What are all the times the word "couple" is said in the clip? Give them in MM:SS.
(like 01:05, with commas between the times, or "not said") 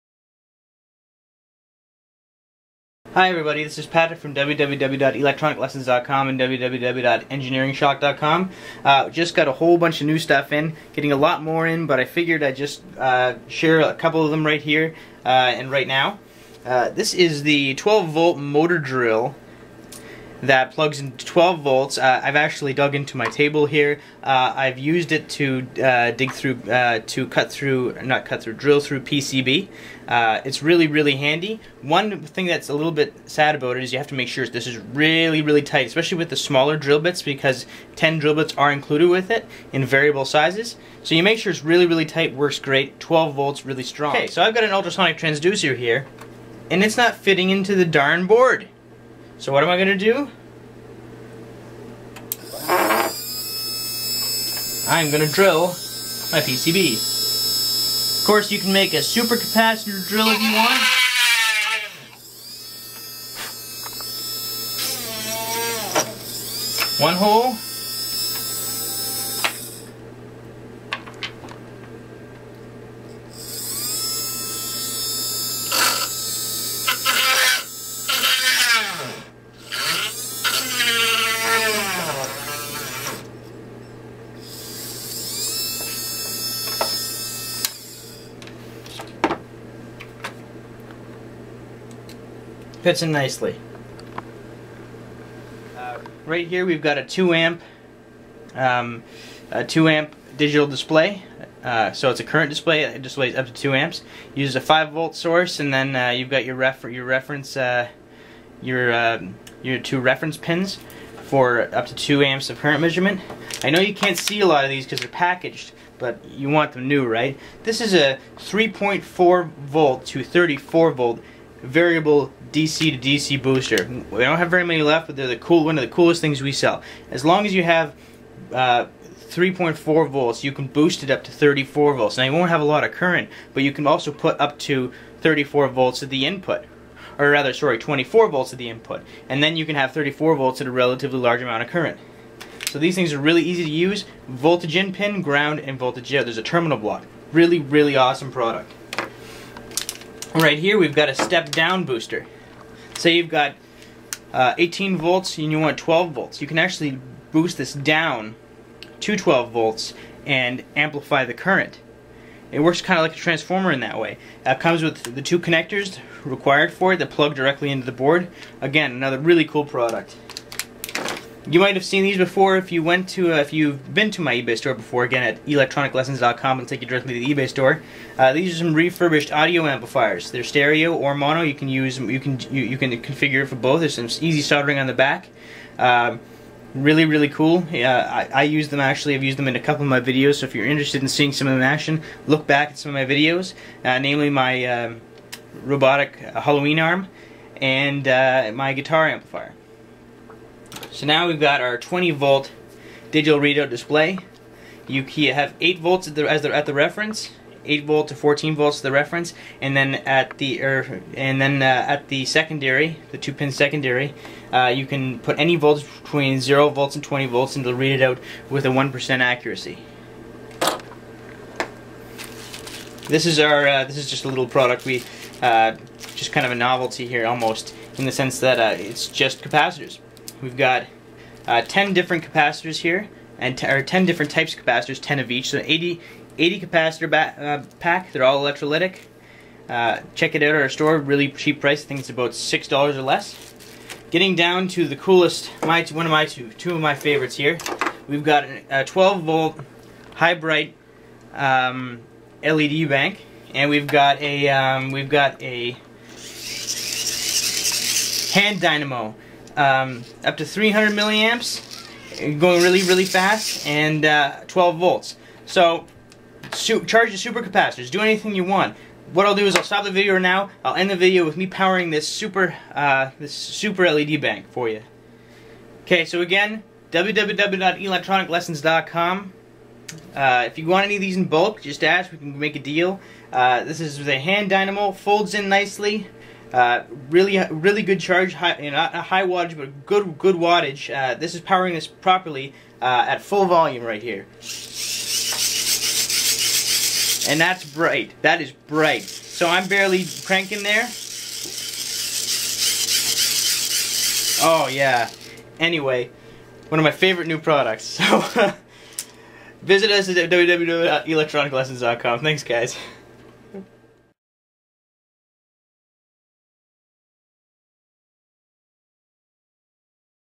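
00:13, 03:09.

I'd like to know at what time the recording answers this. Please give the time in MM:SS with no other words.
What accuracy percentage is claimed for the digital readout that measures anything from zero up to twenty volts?
03:38.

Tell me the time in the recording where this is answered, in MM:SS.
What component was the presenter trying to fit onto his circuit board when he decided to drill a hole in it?
00:44.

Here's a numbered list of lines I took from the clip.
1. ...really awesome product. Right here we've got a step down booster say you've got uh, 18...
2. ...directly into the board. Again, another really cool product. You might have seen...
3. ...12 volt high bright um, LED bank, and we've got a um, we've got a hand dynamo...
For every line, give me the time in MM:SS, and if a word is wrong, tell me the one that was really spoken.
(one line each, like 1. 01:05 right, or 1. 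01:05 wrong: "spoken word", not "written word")
1. 02:27 right
2. 02:47 right
3. 04:08 right.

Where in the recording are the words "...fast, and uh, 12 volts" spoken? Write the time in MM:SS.
04:23.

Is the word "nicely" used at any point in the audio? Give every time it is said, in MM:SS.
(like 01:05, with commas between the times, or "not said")
01:33, 04:45.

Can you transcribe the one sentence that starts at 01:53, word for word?
I know you can't see a lot of these because they're packaged, but you want them new, right?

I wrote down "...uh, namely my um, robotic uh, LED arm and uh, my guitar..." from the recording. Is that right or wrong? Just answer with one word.
wrong.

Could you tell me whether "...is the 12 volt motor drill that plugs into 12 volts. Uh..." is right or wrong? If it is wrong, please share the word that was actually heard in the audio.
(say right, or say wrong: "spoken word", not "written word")
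right.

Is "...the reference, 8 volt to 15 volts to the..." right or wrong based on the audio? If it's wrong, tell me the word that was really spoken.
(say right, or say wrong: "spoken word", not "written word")
wrong: "14", not "15".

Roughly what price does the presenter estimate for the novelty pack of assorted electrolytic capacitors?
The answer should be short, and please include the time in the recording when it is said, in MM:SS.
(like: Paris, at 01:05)
$6, at 04:02.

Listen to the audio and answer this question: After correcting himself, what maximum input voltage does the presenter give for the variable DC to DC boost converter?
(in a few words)
24 volts.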